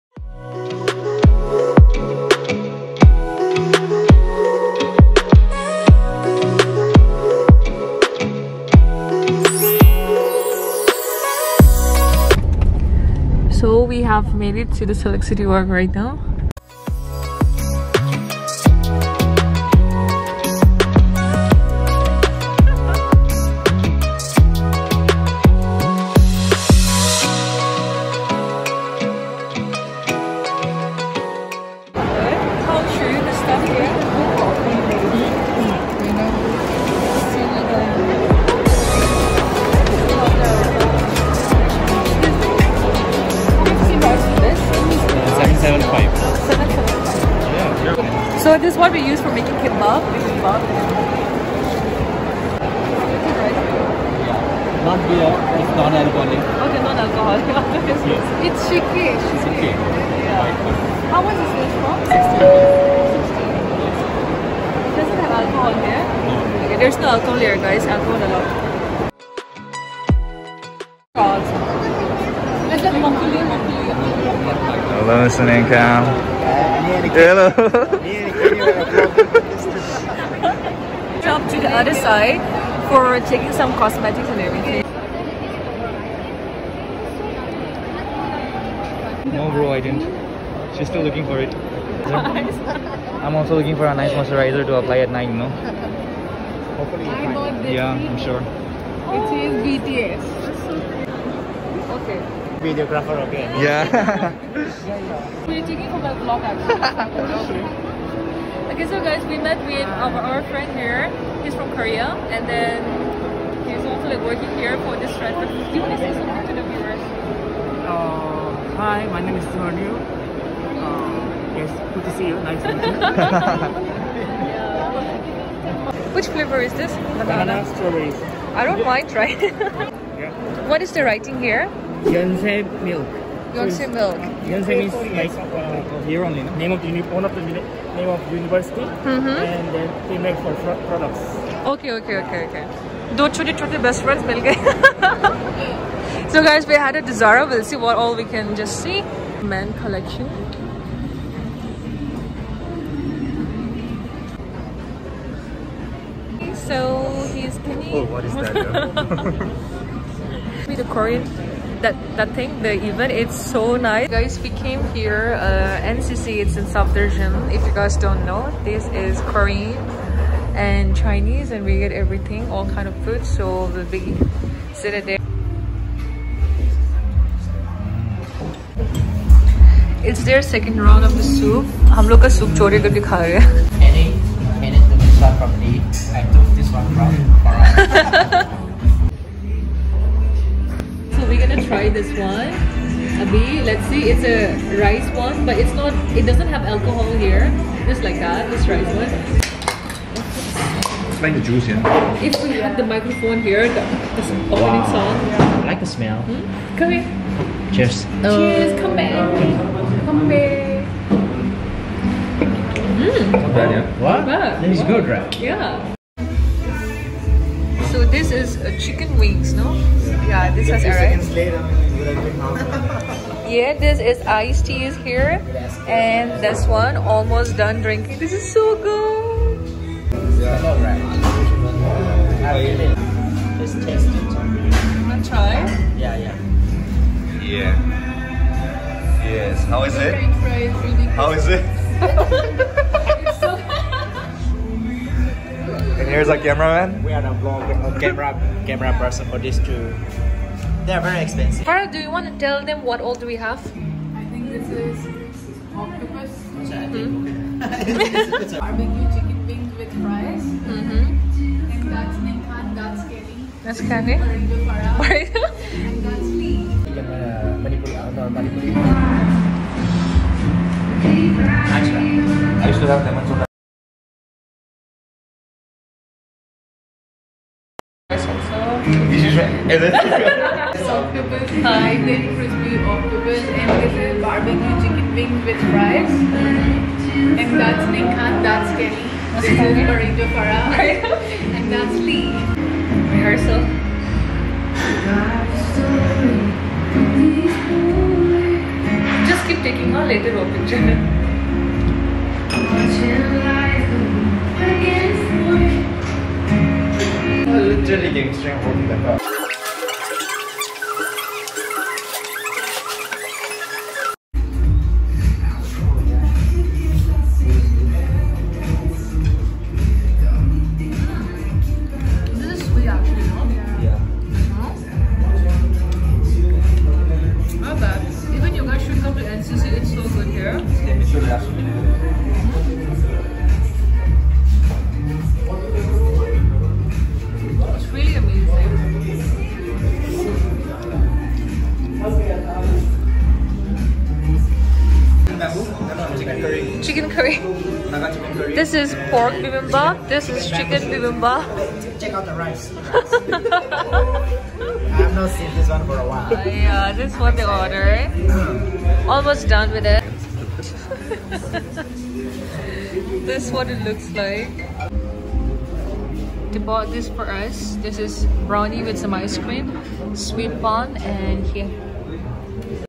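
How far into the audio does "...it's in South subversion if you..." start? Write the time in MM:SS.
02:46.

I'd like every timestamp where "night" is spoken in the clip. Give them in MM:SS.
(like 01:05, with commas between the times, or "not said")
01:35.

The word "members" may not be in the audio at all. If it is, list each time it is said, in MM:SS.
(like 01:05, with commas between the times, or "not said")
not said.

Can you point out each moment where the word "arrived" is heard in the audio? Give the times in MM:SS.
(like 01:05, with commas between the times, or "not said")
03:40.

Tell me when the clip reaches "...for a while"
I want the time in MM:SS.
05:55.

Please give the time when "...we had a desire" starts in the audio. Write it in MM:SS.
02:26.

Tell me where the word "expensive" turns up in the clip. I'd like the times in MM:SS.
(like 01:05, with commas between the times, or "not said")
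04:11.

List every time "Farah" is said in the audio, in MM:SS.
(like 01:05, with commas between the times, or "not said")
04:11, 04:50.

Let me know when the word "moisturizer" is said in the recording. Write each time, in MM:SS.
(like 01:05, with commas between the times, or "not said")
01:34.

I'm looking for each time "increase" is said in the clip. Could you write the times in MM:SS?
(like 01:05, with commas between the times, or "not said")
not said.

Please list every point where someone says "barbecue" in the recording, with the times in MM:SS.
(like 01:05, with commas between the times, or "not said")
04:16, 04:44.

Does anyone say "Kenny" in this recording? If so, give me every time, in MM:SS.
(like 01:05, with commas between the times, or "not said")
02:37, 04:48.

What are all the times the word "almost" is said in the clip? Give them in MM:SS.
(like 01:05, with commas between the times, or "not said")
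03:46, 05:59.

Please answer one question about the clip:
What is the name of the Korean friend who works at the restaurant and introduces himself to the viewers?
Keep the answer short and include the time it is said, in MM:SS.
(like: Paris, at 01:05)
Joryu, at 01:59.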